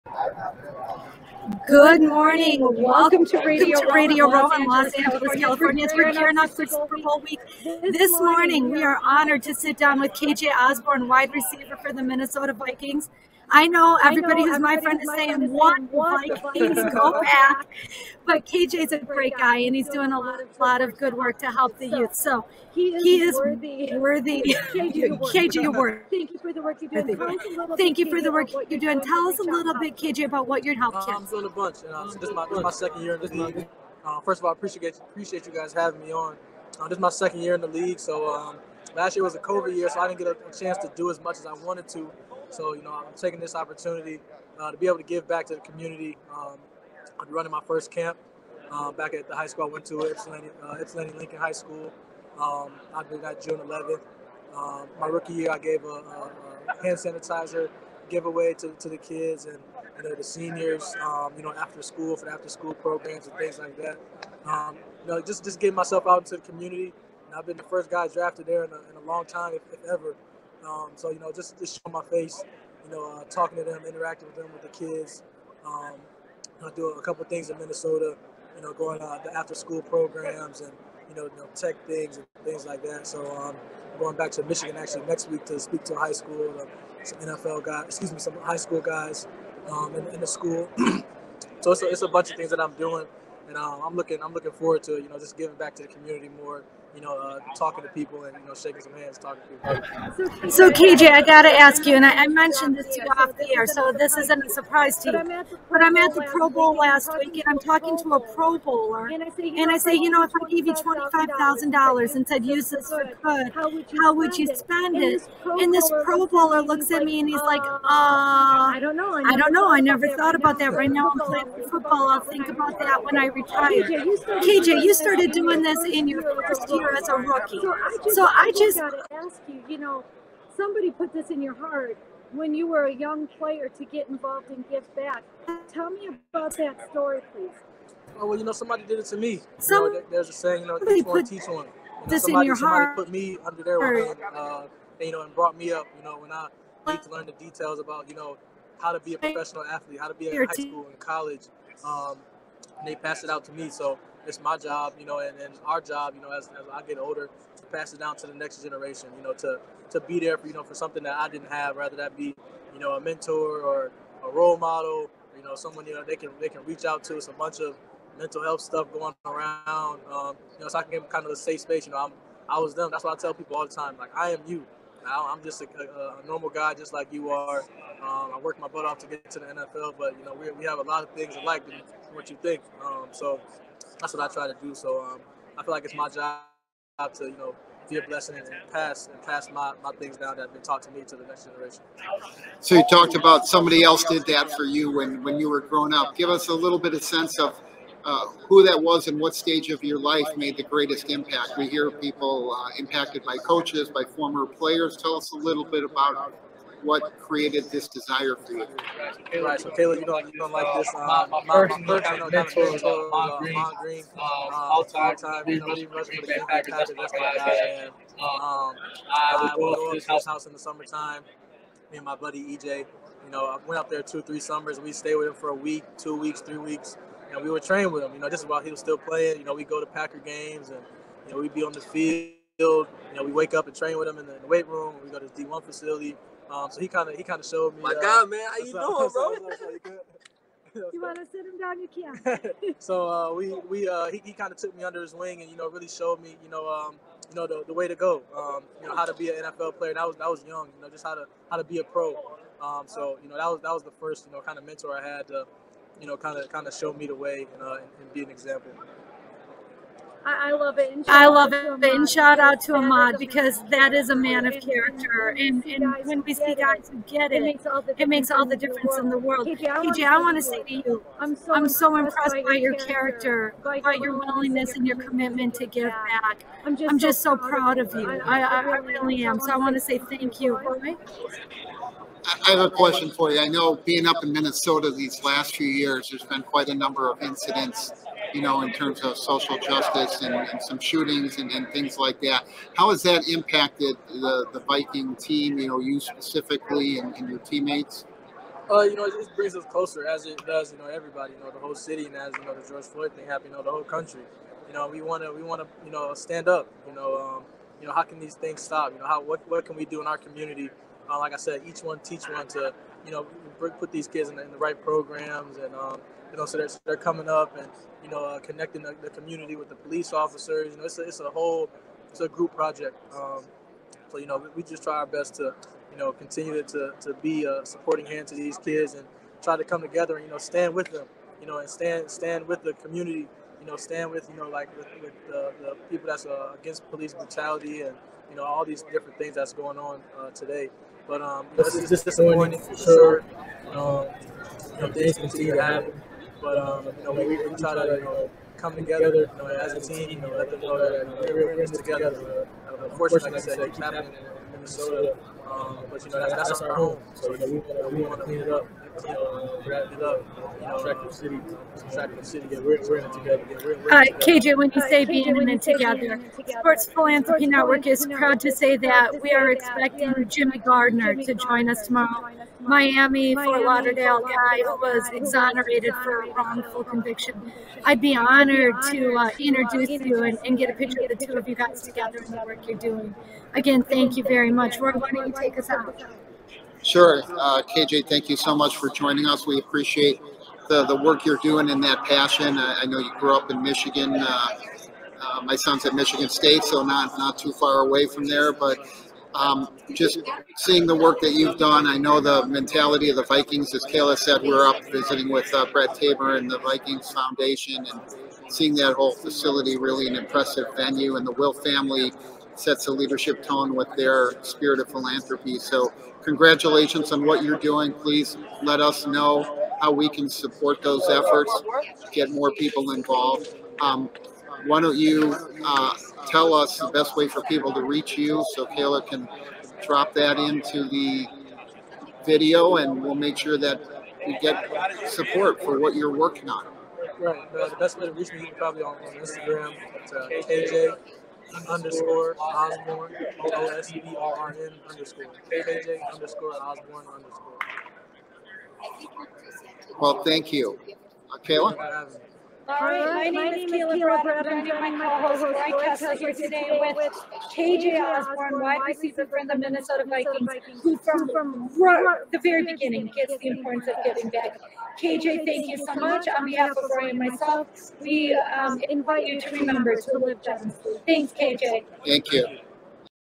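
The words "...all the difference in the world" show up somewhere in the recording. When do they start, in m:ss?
4:28.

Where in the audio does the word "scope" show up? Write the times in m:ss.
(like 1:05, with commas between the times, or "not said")
not said.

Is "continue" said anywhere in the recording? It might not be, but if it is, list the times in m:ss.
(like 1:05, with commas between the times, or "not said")
5:26, 5:45.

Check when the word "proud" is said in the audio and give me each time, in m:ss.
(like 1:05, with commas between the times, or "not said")
4:37, 6:08.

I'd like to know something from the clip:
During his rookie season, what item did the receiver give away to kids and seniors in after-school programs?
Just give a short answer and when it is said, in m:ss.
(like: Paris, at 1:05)
Hand sanitizer, at 0:56.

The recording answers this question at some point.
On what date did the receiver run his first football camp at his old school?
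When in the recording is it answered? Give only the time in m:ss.
0:53.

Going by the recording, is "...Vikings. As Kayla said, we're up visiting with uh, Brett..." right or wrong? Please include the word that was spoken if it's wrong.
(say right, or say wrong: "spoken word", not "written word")
right.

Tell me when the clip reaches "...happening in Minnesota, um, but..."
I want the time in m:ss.
5:53.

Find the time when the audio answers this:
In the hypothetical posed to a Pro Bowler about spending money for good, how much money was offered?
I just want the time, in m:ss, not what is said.
1:50.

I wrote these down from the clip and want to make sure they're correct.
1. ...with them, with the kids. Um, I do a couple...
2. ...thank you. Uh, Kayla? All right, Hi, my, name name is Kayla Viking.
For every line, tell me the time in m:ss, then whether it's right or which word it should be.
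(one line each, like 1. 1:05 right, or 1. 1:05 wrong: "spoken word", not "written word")
1. 1:14 right
2. 7:30 wrong: "Bradham", not "Viking".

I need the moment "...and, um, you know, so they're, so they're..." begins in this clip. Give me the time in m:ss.
5:15.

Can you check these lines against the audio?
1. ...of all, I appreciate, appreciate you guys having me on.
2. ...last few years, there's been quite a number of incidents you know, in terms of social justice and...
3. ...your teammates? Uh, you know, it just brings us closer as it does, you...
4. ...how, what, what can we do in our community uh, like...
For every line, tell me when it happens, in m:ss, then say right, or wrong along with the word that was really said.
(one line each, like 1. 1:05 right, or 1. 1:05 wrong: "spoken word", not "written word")
1. 0:34 right
2. 4:45 right
3. 4:57 right
4. 5:09 right.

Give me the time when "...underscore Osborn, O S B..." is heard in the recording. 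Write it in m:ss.
7:21.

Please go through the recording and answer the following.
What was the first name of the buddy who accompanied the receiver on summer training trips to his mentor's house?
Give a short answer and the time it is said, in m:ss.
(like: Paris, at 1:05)
EJ, at 3:42.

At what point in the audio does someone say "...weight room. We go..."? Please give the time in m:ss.
3:54.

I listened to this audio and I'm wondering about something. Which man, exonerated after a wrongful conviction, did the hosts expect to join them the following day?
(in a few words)
Jimmy Gardner.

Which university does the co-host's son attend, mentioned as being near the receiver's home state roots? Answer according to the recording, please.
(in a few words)
Michigan State.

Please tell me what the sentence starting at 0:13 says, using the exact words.
I know everybody who's my friend is saying, what?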